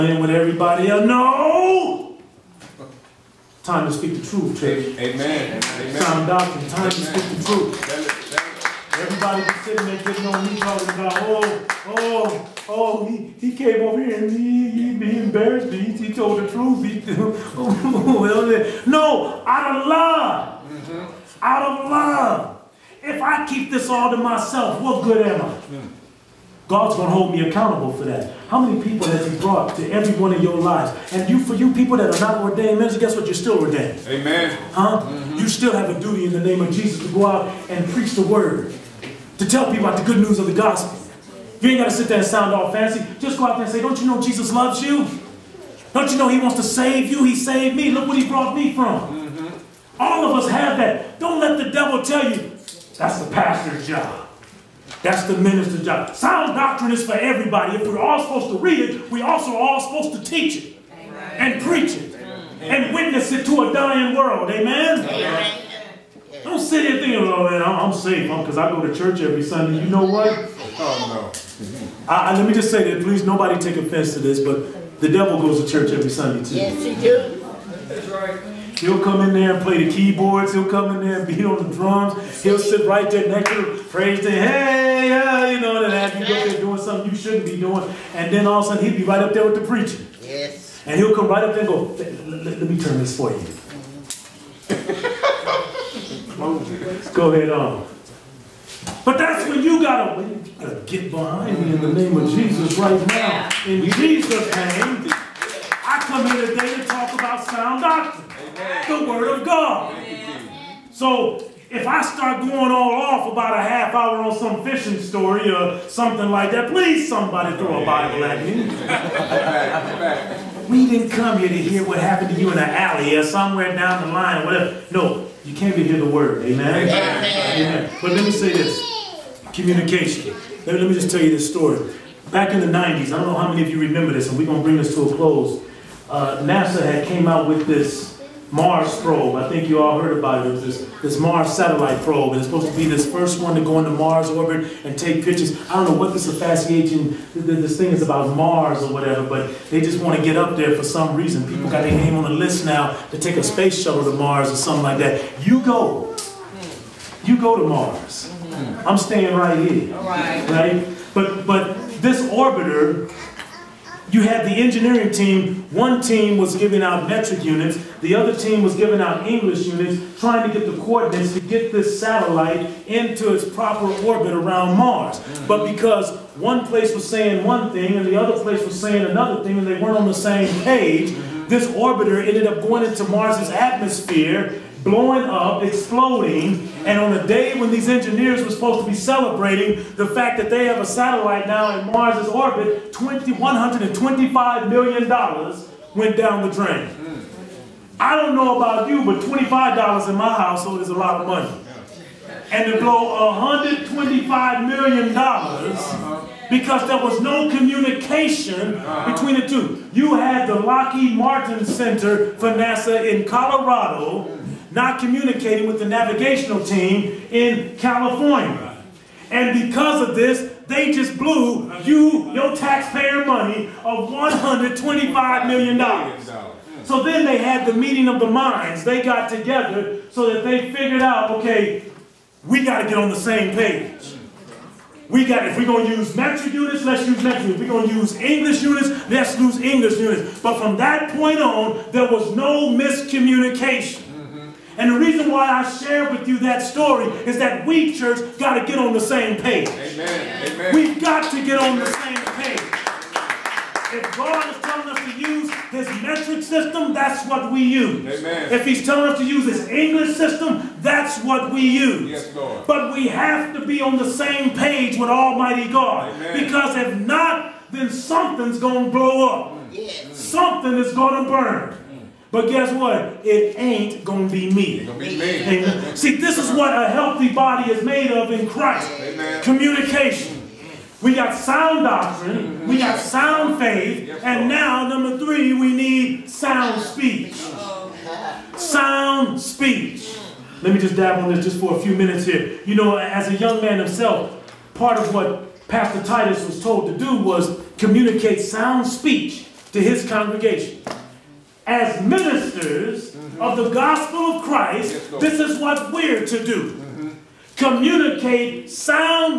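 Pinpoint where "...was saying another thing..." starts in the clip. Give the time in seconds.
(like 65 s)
178 s.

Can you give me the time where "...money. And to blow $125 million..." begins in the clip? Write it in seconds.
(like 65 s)
201 s.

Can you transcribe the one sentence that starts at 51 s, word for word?
Don't let the devil tell you, that's the pastor's job.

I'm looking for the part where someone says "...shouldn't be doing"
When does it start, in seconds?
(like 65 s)
87 s.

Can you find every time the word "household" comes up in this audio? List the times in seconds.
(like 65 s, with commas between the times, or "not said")
200 s.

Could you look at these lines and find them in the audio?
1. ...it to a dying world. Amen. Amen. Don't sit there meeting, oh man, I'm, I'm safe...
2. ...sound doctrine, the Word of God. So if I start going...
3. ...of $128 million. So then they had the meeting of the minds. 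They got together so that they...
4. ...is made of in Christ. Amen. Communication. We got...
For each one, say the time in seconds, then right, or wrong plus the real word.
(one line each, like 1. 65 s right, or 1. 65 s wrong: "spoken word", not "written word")
1. 63 s wrong: "thinking", not "meeting"
2. 107 s right
3. 223 s wrong: "125", not "128"
4. 277 s right.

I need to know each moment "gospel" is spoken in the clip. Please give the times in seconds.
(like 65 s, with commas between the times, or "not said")
40 s, 303 s.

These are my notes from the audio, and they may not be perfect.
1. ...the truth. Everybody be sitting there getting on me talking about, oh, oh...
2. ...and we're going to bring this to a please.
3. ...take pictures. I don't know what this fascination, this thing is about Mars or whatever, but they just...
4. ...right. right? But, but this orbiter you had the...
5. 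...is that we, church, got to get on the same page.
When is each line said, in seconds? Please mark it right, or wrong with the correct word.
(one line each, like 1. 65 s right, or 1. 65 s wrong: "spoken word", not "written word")
1. 7 s right
2. 134 s wrong: "close", not "please"
3. 144 s right
4. 160 s right
5. 247 s right.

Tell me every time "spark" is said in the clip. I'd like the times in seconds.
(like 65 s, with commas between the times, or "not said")
not said.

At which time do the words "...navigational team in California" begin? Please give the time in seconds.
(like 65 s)
215 s.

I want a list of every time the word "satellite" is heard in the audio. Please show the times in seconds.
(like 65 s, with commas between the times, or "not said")
141 s, 171 s, 190 s.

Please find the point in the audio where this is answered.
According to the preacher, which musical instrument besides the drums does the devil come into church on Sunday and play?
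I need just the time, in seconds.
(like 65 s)
79 s.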